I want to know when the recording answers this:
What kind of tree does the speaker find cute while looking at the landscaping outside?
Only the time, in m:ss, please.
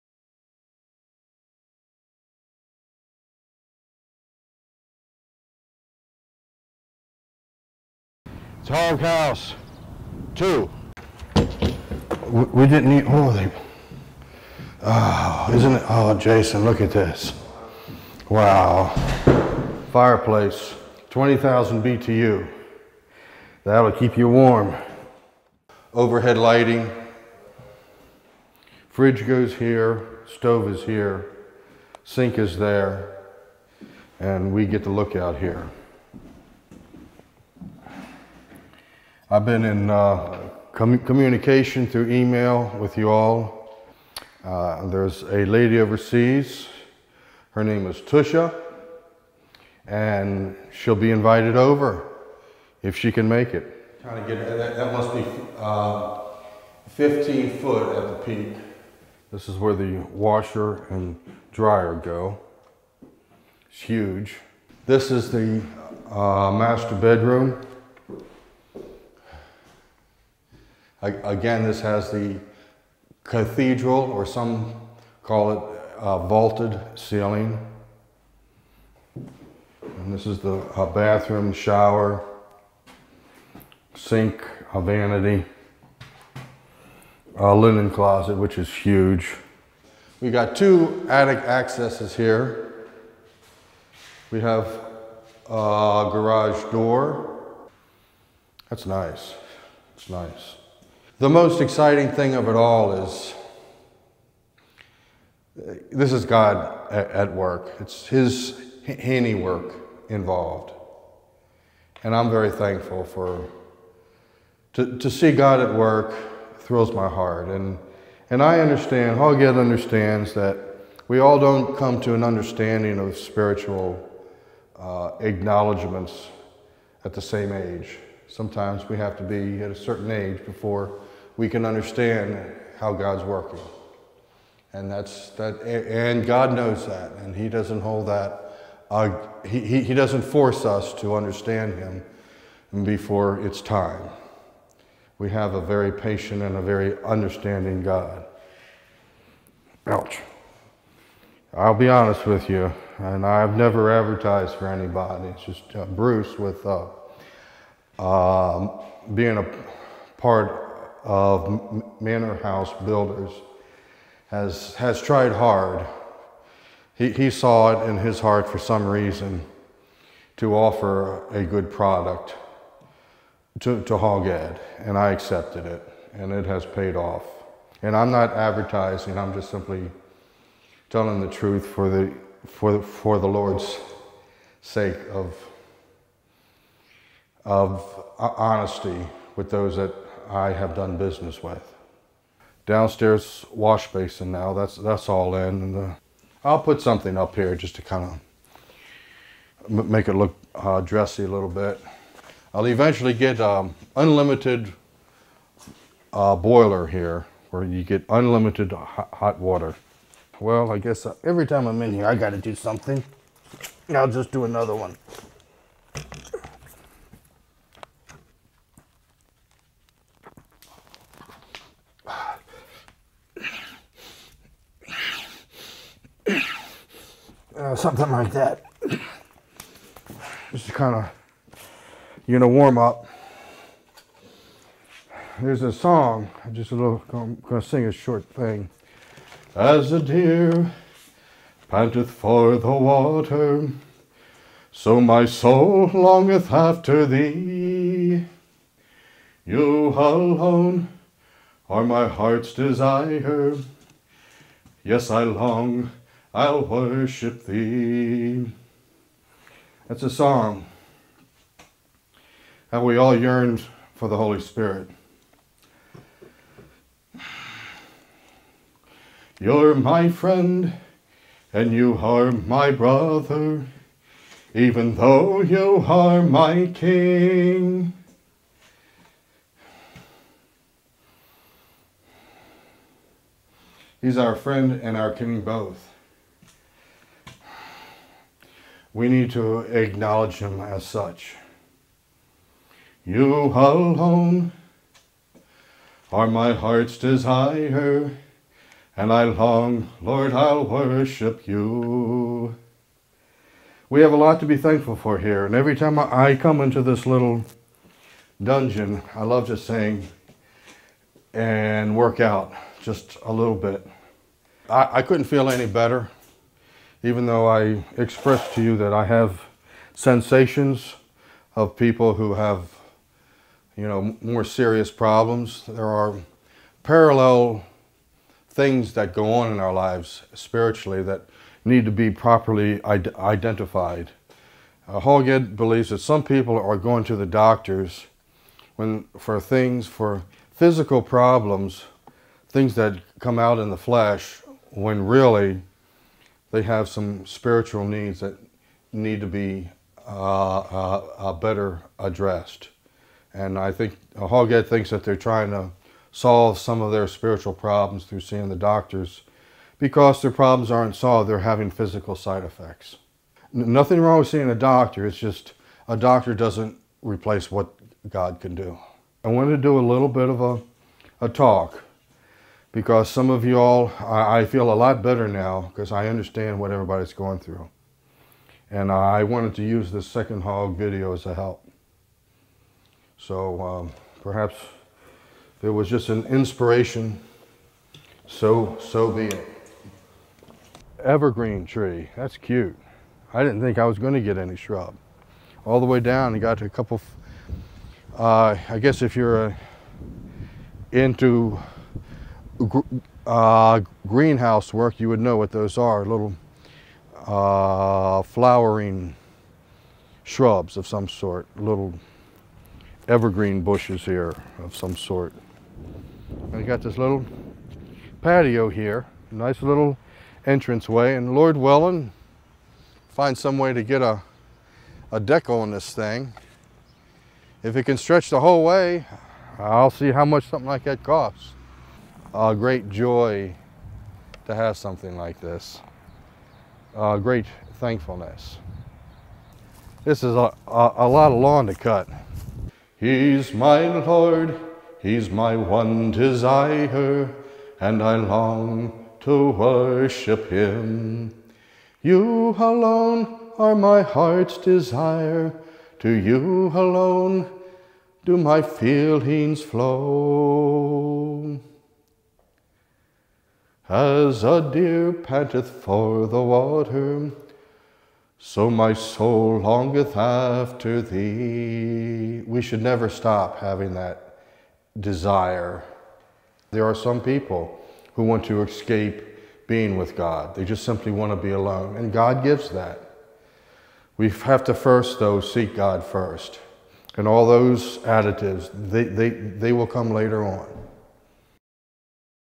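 6:31.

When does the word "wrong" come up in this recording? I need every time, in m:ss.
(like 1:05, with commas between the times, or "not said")
6:04.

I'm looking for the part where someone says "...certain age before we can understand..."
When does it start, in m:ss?
2:09.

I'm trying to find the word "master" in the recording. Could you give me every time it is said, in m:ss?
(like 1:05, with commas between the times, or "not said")
1:06.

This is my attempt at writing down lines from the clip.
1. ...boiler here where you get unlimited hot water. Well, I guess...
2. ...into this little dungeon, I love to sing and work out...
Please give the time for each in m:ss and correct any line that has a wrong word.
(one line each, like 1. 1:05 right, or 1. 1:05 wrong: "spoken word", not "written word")
1. 3:26 right
2. 5:06 right.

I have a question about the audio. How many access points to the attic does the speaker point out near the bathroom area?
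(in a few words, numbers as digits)
2.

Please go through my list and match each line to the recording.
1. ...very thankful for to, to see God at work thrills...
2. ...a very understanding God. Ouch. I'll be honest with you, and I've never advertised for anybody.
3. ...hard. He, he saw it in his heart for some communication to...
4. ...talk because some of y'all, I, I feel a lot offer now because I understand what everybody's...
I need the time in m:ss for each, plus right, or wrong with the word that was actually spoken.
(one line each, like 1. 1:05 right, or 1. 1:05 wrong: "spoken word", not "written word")
1. 1:52 right
2. 2:26 right
3. 2:45 wrong: "reason", not "communication"
4. 6:11 wrong: "better", not "offer".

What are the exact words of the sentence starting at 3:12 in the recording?
Downstairs wash basin now, that's, that's all in.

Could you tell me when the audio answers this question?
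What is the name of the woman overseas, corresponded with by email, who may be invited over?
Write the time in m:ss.
0:48.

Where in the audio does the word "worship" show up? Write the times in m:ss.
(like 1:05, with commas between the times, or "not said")
4:16, 5:00, 7:29.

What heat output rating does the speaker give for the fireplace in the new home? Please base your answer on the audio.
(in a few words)
20,000 BTU.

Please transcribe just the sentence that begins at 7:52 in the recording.
We should never stop having that desire.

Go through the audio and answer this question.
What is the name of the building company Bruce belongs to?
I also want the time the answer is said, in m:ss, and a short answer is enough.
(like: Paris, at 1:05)
Manor House Builders, at 2:41.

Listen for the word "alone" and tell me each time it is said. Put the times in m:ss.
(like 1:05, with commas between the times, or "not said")
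4:09, 4:53, 7:32, 7:36, 8:01.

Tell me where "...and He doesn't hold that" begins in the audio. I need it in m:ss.
2:17.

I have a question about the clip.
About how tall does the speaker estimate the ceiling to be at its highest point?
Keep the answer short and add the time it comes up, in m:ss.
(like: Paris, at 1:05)
15 feet, at 0:56.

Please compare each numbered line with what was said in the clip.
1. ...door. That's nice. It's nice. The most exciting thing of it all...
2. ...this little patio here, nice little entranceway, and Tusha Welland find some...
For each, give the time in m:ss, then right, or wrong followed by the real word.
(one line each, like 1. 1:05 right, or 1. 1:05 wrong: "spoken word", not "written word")
1. 1:36 right
2. 6:56 wrong: "Lord", not "Tusha".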